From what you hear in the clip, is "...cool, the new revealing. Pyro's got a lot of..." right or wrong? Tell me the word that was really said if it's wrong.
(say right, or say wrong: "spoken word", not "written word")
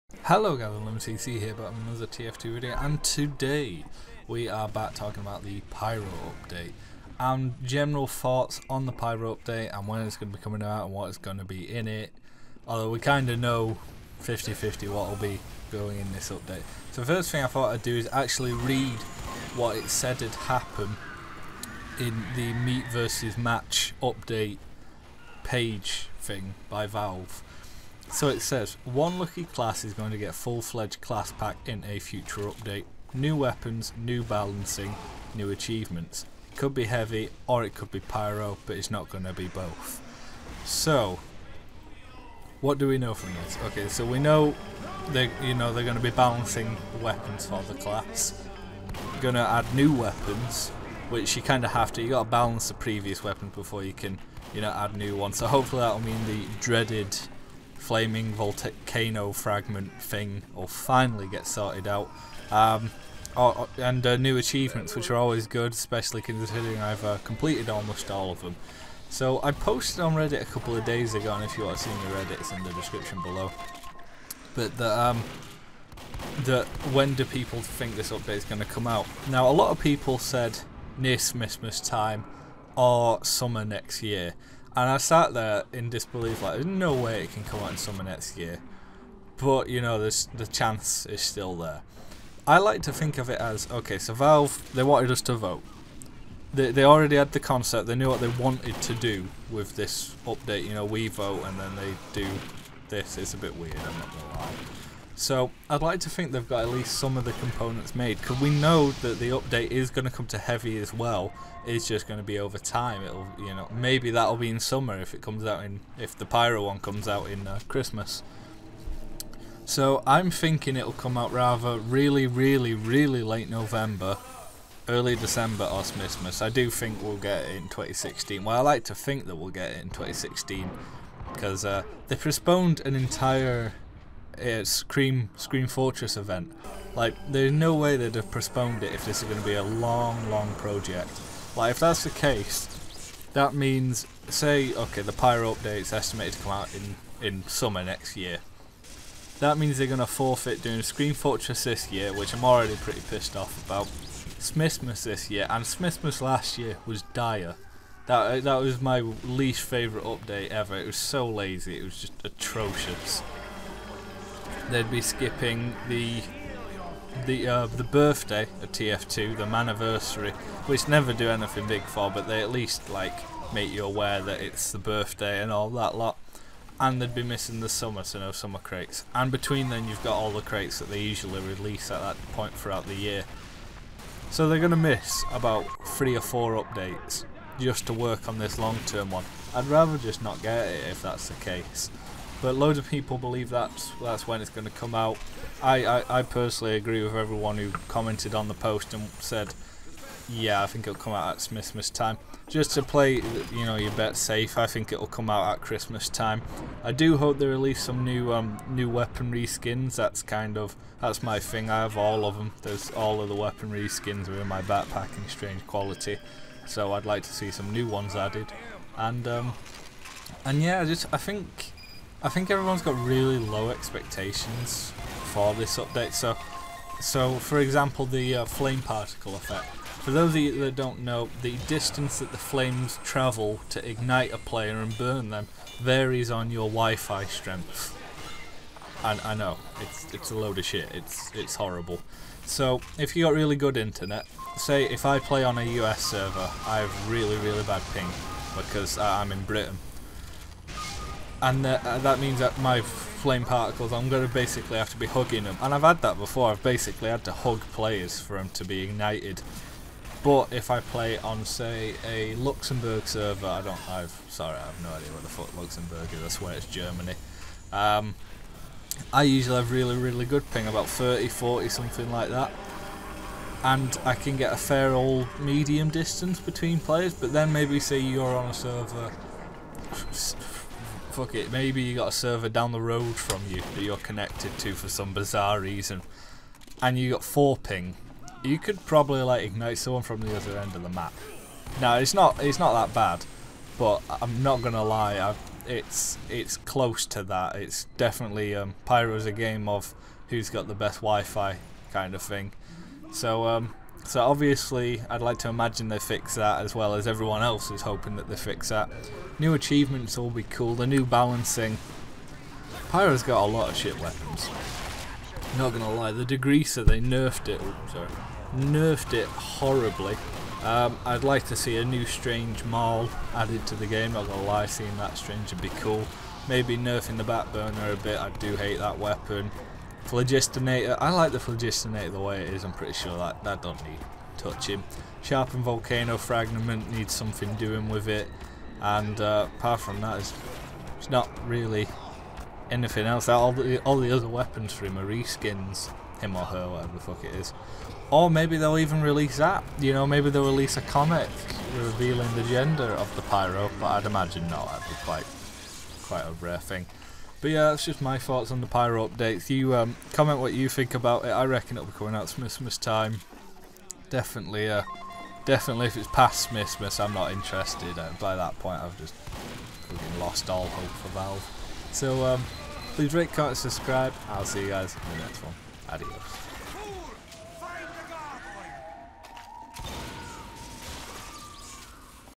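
wrong: "balancing", not "revealing".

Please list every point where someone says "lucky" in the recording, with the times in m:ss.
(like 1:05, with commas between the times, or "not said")
0:29.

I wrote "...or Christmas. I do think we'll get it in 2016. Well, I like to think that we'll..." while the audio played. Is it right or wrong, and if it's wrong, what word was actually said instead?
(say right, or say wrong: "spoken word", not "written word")
right.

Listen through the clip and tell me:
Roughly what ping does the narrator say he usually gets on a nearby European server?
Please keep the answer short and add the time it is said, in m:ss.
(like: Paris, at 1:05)
30 to 40, at 4:30.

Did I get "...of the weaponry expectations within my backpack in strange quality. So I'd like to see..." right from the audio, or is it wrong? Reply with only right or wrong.
wrong.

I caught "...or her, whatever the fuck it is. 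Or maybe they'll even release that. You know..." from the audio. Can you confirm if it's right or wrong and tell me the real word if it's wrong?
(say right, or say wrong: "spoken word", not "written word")
right.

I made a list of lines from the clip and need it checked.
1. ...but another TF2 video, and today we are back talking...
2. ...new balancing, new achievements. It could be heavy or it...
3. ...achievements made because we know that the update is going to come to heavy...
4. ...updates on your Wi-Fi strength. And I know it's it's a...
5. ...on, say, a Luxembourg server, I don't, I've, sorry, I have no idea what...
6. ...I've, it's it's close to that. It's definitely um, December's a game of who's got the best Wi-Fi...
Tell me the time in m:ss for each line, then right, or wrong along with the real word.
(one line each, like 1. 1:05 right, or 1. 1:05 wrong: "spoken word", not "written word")
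1. 0:01 right
2. 0:33 right
3. 1:47 wrong: "components", not "achievements"
4. 3:55 wrong: "varies", not "updates"
5. 4:21 right
6. 4:55 wrong: "Pyro", not "December".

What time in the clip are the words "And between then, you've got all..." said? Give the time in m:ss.
2:59.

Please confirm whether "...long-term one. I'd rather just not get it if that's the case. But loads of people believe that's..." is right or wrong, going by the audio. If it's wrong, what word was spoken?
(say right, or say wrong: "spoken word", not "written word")
right.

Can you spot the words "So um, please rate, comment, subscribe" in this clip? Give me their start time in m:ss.
6:11.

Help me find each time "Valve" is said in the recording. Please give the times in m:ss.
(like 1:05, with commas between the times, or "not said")
0:26, 1:34, 6:11.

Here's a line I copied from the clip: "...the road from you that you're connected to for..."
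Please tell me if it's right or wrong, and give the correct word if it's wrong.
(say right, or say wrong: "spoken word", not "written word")
right.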